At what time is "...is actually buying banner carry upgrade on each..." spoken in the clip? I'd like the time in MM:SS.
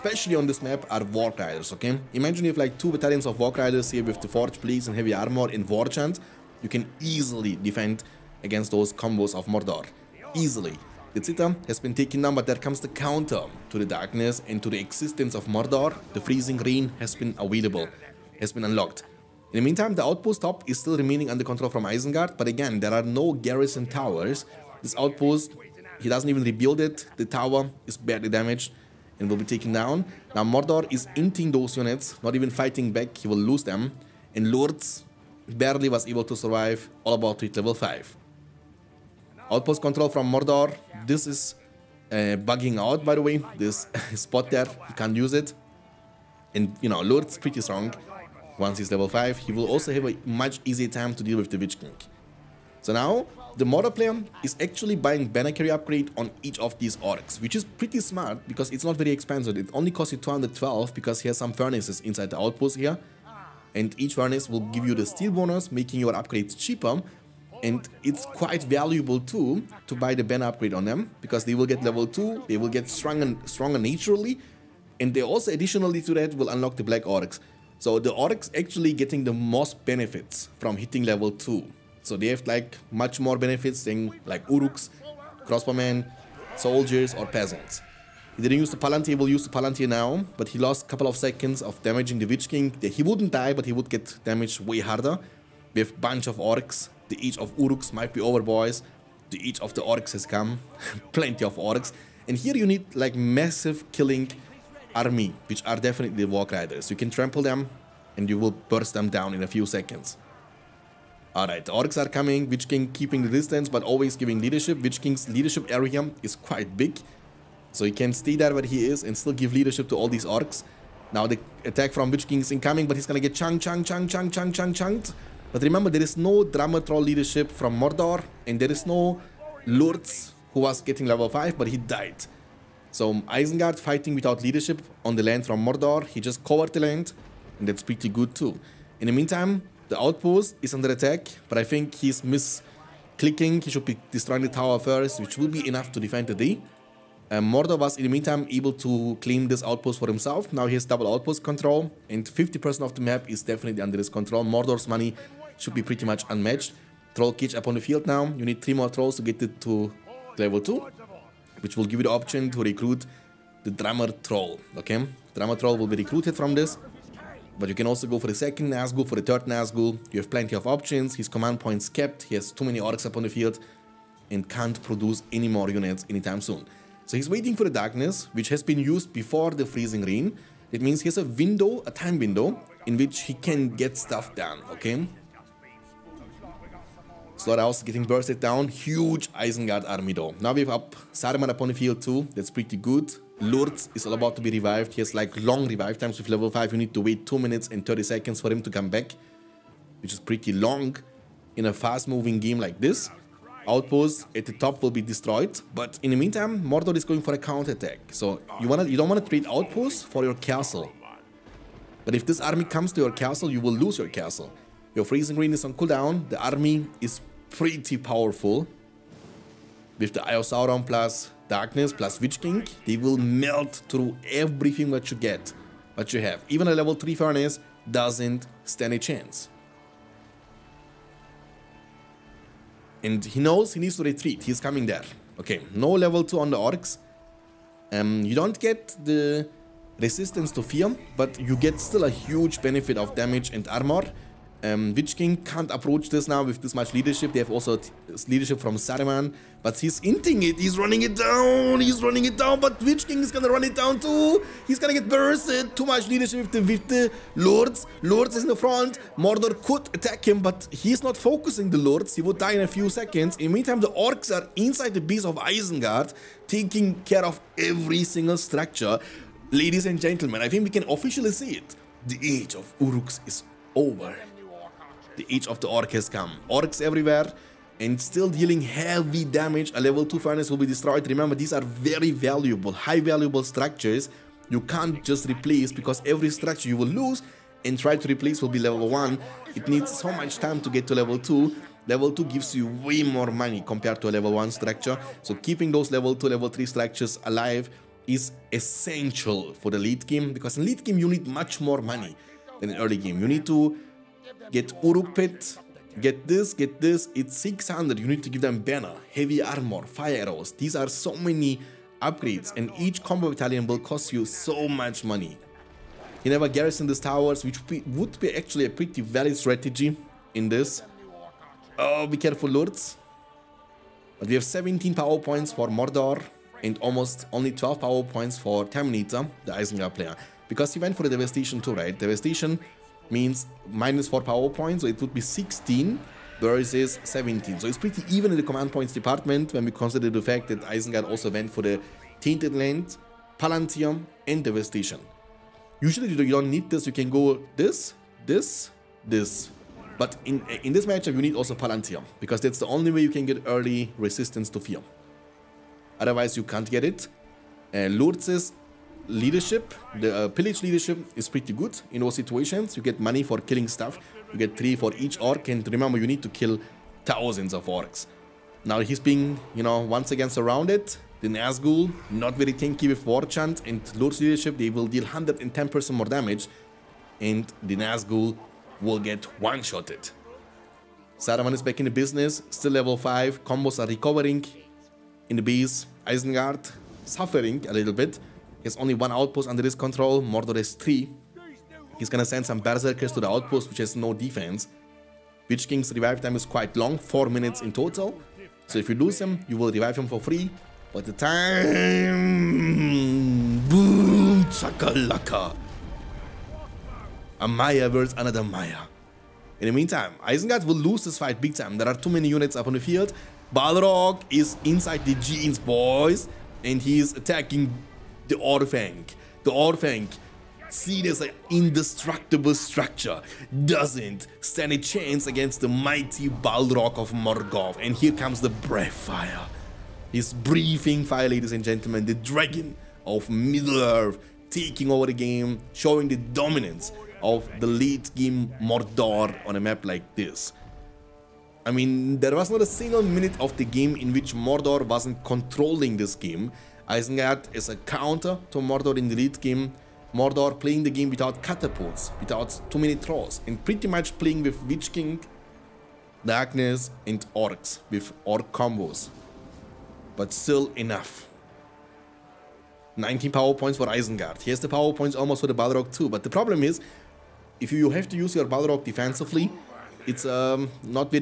00:54.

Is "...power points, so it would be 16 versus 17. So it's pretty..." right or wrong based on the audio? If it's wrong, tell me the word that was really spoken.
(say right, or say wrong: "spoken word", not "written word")
right.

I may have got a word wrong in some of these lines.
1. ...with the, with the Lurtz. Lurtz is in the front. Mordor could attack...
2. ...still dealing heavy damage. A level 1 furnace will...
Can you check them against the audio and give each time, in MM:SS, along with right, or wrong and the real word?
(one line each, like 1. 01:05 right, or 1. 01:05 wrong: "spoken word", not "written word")
1. 04:16 right
2. 04:38 wrong: "2", not "1".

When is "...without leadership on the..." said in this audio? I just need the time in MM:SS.
02:14.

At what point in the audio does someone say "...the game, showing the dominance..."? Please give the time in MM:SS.
07:15.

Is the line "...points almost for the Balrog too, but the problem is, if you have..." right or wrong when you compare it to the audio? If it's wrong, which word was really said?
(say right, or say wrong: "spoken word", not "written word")
right.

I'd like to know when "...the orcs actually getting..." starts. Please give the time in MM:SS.
01:17.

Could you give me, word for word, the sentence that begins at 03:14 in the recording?
He has like long revive times with level 5.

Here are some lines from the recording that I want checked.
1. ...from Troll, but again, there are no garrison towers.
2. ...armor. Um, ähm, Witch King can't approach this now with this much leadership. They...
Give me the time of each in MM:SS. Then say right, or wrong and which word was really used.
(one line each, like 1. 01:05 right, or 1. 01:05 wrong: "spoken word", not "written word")
1. 00:21 wrong: "Isengard", not "Troll"
2. 04:03 right.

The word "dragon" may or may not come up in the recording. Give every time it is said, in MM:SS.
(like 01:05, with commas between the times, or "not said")
07:12.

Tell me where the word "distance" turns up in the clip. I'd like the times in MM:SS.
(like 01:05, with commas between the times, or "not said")
01:53.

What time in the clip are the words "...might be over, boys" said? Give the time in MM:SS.
01:37.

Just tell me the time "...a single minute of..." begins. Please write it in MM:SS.
07:22.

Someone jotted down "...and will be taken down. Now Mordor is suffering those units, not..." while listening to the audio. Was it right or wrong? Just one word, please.
wrong.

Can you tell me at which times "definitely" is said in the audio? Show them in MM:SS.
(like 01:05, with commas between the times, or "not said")
01:45, 02:33.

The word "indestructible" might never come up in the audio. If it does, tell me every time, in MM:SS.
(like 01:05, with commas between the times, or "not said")
07:01.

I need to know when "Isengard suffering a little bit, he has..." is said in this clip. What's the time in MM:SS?
06:26.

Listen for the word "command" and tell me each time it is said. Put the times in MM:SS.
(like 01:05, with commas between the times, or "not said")
02:51, 05:38.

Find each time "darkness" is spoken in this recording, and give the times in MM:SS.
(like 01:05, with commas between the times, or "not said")
00:13, 02:57, 03:41, 07:36.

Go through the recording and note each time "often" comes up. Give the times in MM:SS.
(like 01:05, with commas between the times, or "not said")
not said.